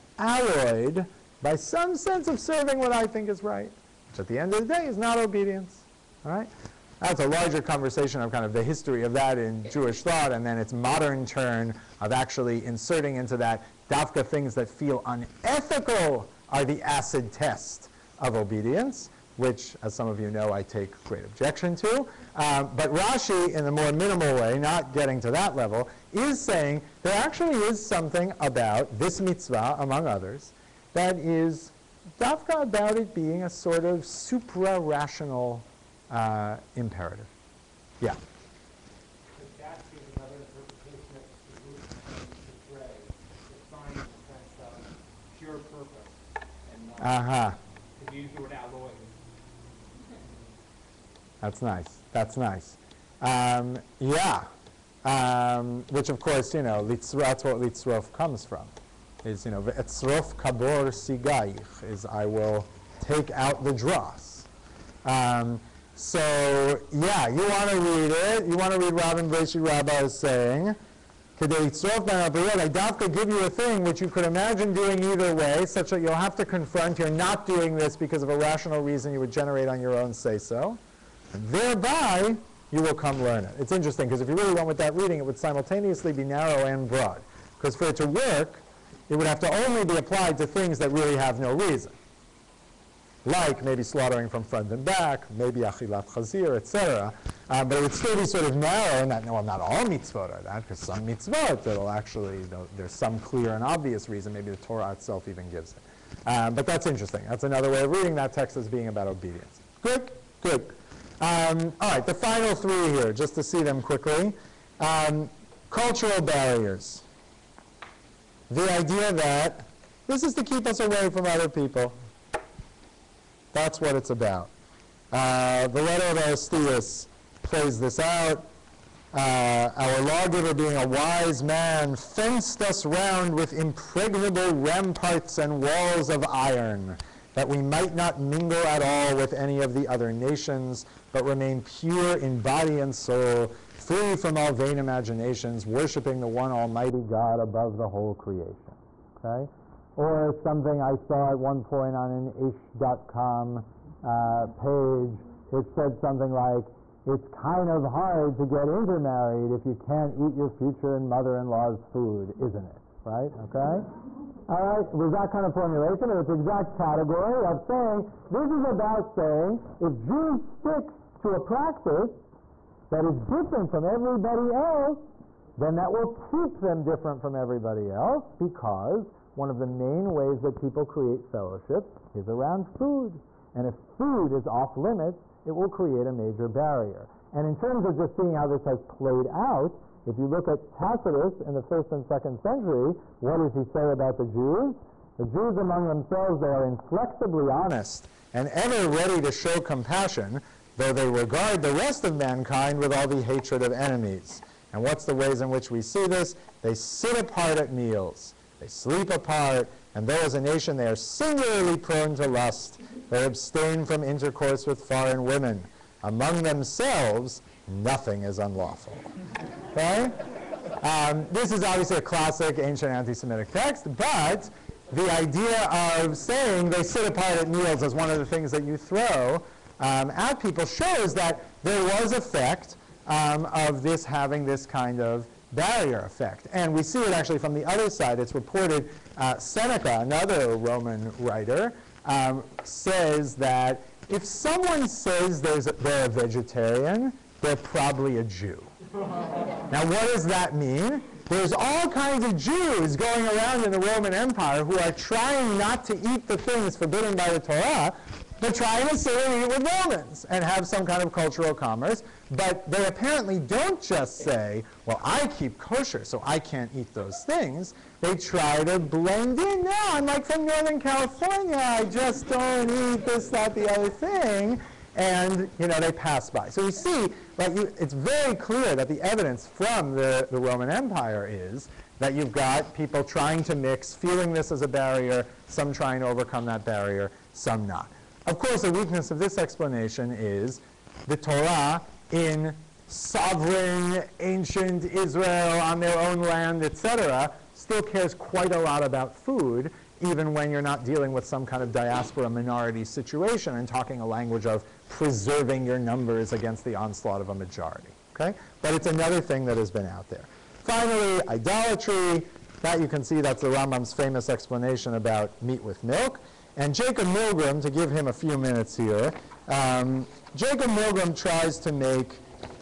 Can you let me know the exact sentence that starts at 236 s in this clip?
And we see it actually from the other side.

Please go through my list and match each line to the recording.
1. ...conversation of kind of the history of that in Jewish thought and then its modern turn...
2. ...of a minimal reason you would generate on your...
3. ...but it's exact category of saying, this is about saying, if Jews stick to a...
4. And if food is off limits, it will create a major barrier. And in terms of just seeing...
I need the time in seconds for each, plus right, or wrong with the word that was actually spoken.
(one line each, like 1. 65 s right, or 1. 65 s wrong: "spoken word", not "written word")
1. 7 s right
2. 78 s wrong: "rational", not "minimal"
3. 166 s right
4. 183 s right.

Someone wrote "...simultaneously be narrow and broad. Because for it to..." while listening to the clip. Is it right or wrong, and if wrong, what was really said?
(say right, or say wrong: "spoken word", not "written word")
right.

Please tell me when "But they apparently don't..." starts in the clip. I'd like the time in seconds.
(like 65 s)
262 s.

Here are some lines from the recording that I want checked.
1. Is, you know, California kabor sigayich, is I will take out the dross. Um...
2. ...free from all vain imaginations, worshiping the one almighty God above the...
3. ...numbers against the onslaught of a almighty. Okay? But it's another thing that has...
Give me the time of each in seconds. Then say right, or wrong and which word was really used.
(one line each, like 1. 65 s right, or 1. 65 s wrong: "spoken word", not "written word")
1. 59 s wrong: "Etzrof", not "California"
2. 143 s right
3. 305 s wrong: "majority", not "almighty".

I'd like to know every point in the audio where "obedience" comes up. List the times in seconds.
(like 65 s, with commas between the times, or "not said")
5 s, 18 s, 109 s.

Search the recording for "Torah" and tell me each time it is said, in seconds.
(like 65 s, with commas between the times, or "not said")
104 s, 257 s, 291 s.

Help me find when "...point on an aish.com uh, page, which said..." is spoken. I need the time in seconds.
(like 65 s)
151 s.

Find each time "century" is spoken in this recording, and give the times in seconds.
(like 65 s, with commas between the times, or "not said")
192 s.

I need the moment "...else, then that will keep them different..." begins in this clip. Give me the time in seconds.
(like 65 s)
174 s.